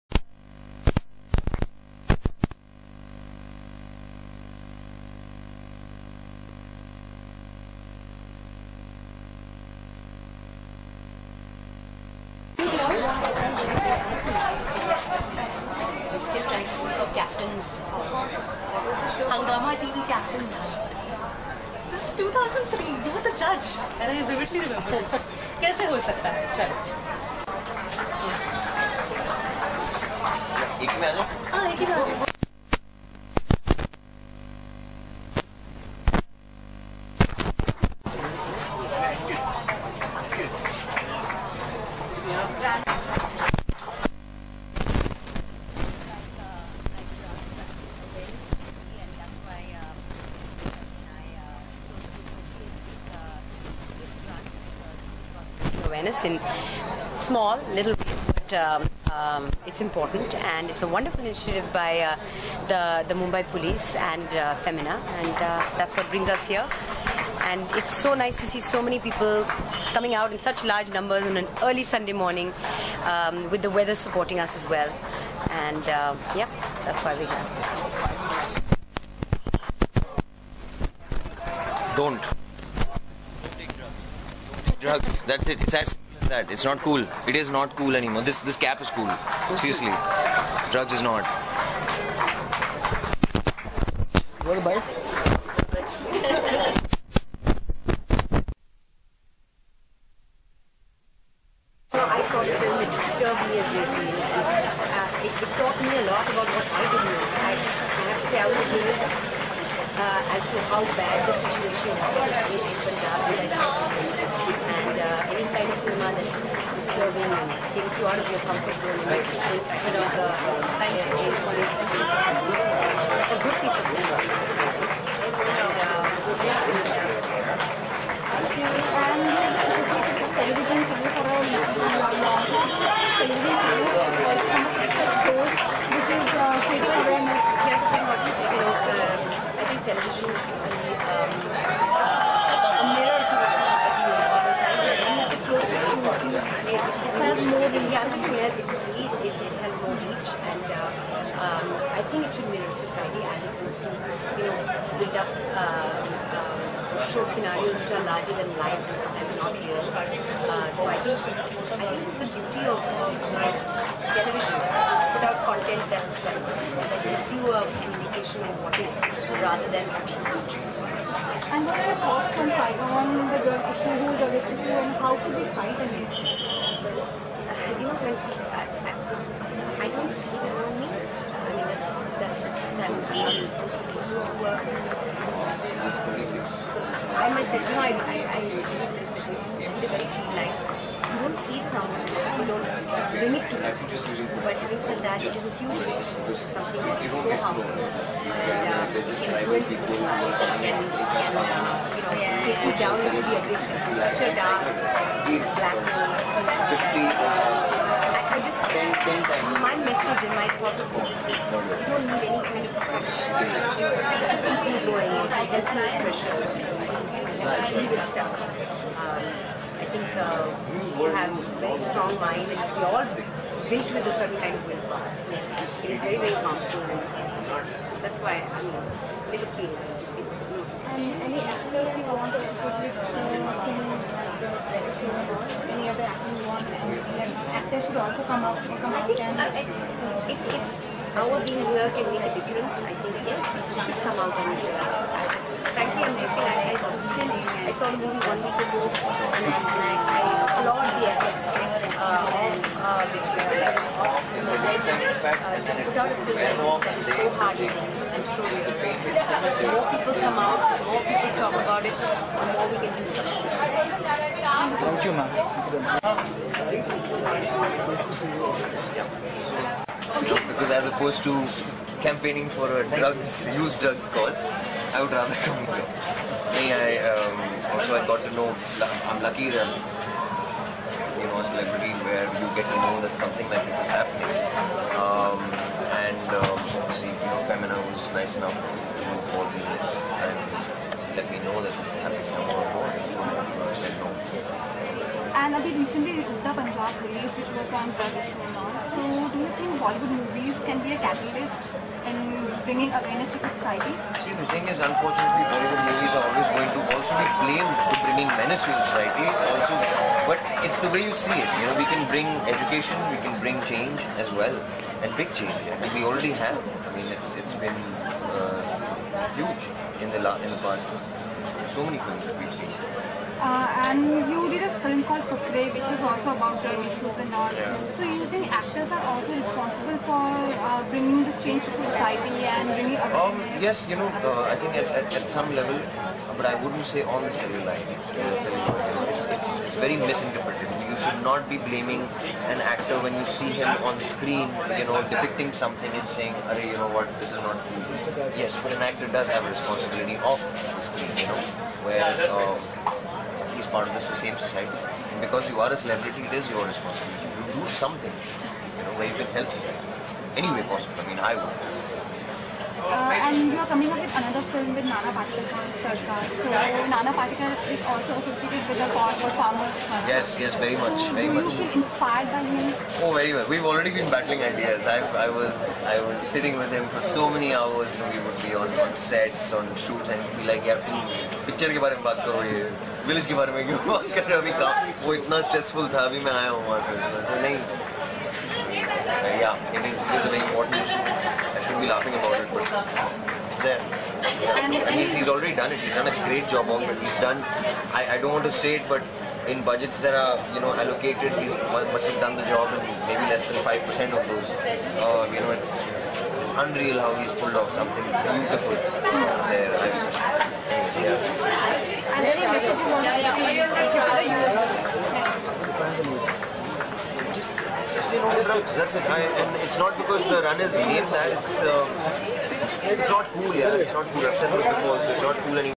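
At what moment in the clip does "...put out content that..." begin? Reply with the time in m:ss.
2:44.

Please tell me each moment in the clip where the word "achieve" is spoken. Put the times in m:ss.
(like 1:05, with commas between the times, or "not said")
not said.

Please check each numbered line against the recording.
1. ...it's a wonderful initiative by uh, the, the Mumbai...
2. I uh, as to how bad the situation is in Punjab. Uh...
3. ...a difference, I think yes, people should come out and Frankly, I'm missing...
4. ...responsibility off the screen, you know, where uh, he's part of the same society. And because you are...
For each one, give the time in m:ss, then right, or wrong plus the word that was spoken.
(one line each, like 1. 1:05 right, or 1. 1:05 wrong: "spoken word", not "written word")
1. 1:00 right
2. 1:48 right
3. 4:02 right
4. 5:49 right.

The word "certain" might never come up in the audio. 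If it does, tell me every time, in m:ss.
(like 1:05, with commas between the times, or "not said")
3:44.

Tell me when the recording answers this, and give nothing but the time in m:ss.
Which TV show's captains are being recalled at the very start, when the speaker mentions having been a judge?
0:19.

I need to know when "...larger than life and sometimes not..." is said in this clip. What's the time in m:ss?
2:38.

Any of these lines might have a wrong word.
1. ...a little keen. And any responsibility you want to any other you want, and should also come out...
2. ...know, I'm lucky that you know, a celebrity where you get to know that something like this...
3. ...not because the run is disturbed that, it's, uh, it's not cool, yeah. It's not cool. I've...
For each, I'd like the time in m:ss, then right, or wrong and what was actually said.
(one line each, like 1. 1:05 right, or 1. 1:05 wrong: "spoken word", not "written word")
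1. 3:48 wrong: "activity", not "responsibility"
2. 4:38 right
3. 6:59 wrong: "named", not "disturbed".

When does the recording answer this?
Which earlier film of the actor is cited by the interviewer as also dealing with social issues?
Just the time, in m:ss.
5:25.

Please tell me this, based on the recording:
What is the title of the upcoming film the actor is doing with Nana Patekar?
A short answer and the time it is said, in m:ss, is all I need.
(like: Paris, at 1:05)
Sarkar, at 6:05.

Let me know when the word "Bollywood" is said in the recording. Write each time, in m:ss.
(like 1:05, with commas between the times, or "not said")
4:59, 5:05.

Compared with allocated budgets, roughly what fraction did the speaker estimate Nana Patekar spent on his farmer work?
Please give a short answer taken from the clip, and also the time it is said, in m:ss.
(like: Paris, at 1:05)
less than 5 percent, at 6:43.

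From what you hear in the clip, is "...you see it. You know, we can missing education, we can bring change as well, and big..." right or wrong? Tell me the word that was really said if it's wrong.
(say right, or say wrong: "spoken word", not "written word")
wrong: "bring", not "missing".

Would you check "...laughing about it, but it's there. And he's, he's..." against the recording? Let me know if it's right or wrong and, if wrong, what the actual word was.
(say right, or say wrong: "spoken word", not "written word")
right.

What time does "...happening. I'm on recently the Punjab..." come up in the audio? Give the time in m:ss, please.
4:52.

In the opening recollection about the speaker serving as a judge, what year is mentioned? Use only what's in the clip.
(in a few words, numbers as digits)
2003.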